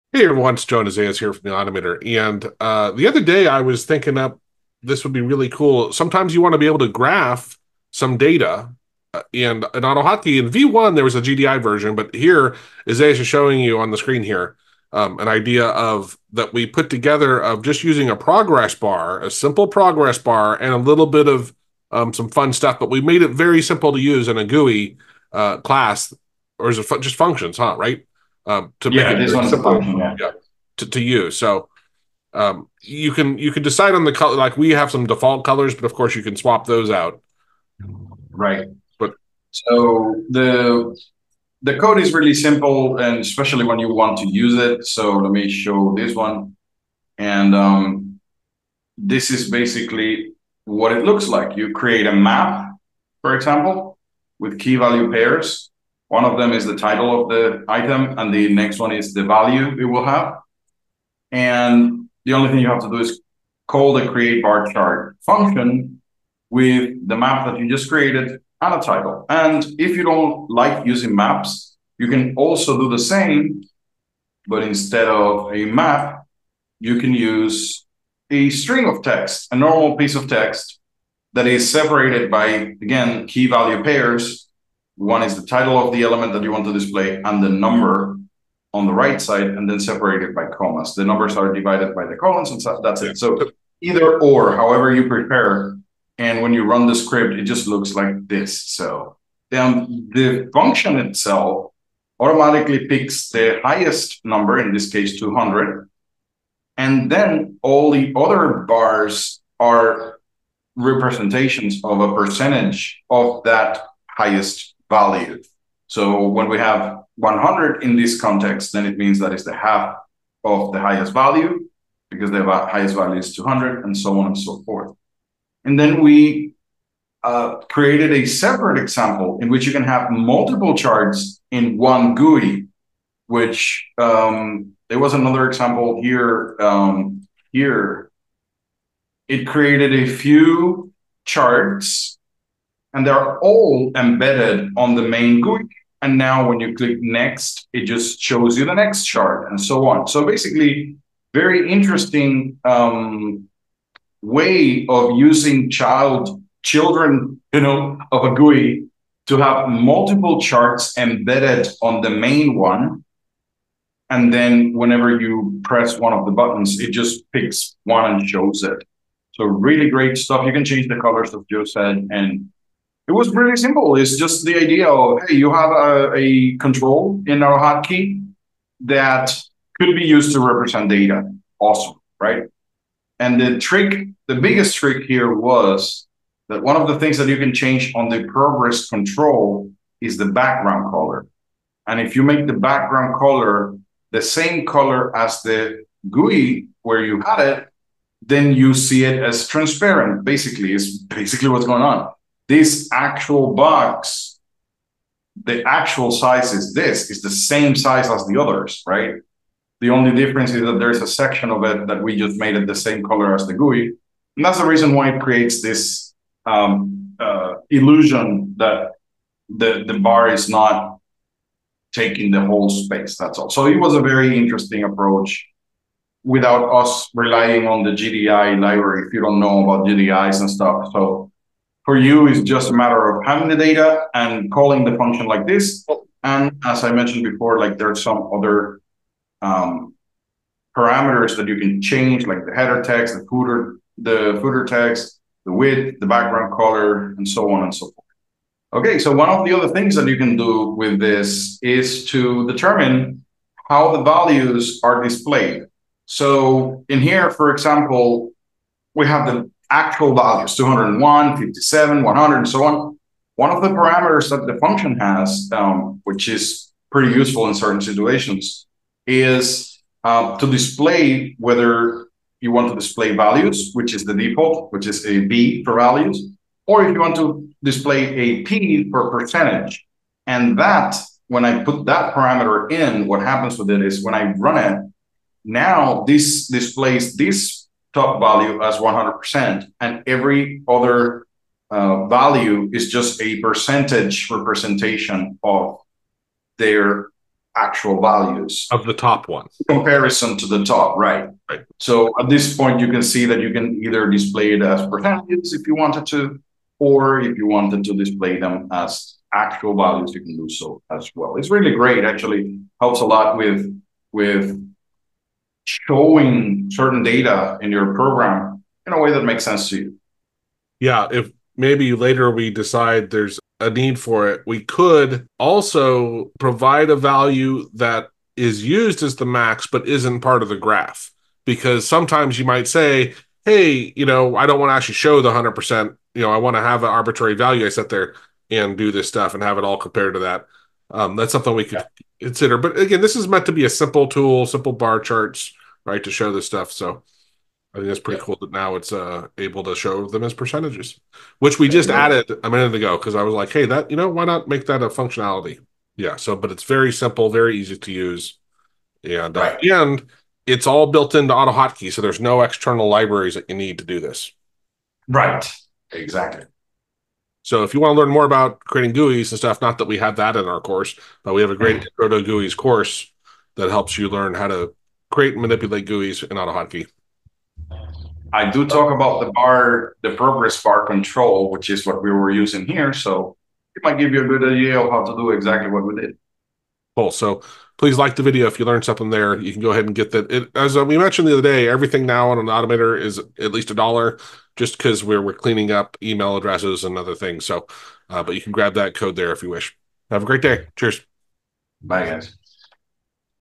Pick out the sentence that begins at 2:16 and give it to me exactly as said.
Um, here, it created a few charts and they're all embedded on the main GUI.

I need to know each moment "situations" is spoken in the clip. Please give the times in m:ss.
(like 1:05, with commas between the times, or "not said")
4:27.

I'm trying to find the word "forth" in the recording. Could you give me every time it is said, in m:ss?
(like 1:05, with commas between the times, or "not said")
2:04, 4:07.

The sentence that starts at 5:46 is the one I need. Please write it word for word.
So I think that's pretty yeah.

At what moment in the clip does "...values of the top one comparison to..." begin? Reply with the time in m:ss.
4:58.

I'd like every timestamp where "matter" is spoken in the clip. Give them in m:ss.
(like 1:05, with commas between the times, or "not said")
3:52.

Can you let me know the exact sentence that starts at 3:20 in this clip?
Basically, is basically what's going on this actual box, the actual size is this, is the same size as the others, right?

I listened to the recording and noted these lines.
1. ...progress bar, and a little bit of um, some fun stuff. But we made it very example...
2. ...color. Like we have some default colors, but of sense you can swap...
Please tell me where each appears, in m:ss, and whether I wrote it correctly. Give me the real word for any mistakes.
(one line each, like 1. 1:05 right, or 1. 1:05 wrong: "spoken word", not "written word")
1. 0:19 wrong: "simple", not "example"
2. 0:34 wrong: "course", not "sense".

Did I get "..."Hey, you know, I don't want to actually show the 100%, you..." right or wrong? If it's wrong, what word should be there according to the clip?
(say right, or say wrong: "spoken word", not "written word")
right.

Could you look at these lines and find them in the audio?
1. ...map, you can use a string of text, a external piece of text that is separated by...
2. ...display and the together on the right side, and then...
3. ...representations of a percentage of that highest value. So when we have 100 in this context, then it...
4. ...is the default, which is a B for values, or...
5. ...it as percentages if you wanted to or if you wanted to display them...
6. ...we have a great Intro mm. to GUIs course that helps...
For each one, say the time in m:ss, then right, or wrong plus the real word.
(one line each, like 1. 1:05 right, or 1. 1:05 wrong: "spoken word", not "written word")
1. 1:15 wrong: "normal", not "external"
2. 1:26 wrong: "number", not "together"
3. 1:50 right
4. 4:33 right
5. 5:04 right
6. 6:11 right.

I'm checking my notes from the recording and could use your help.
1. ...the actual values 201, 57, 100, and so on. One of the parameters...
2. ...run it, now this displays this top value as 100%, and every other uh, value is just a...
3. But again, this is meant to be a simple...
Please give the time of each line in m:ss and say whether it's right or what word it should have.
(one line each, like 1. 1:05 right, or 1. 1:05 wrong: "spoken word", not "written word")
1. 4:19 right
2. 4:44 right
3. 5:42 right.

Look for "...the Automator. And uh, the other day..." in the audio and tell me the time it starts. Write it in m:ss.
0:01.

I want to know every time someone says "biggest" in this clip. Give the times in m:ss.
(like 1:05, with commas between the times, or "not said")
3:04.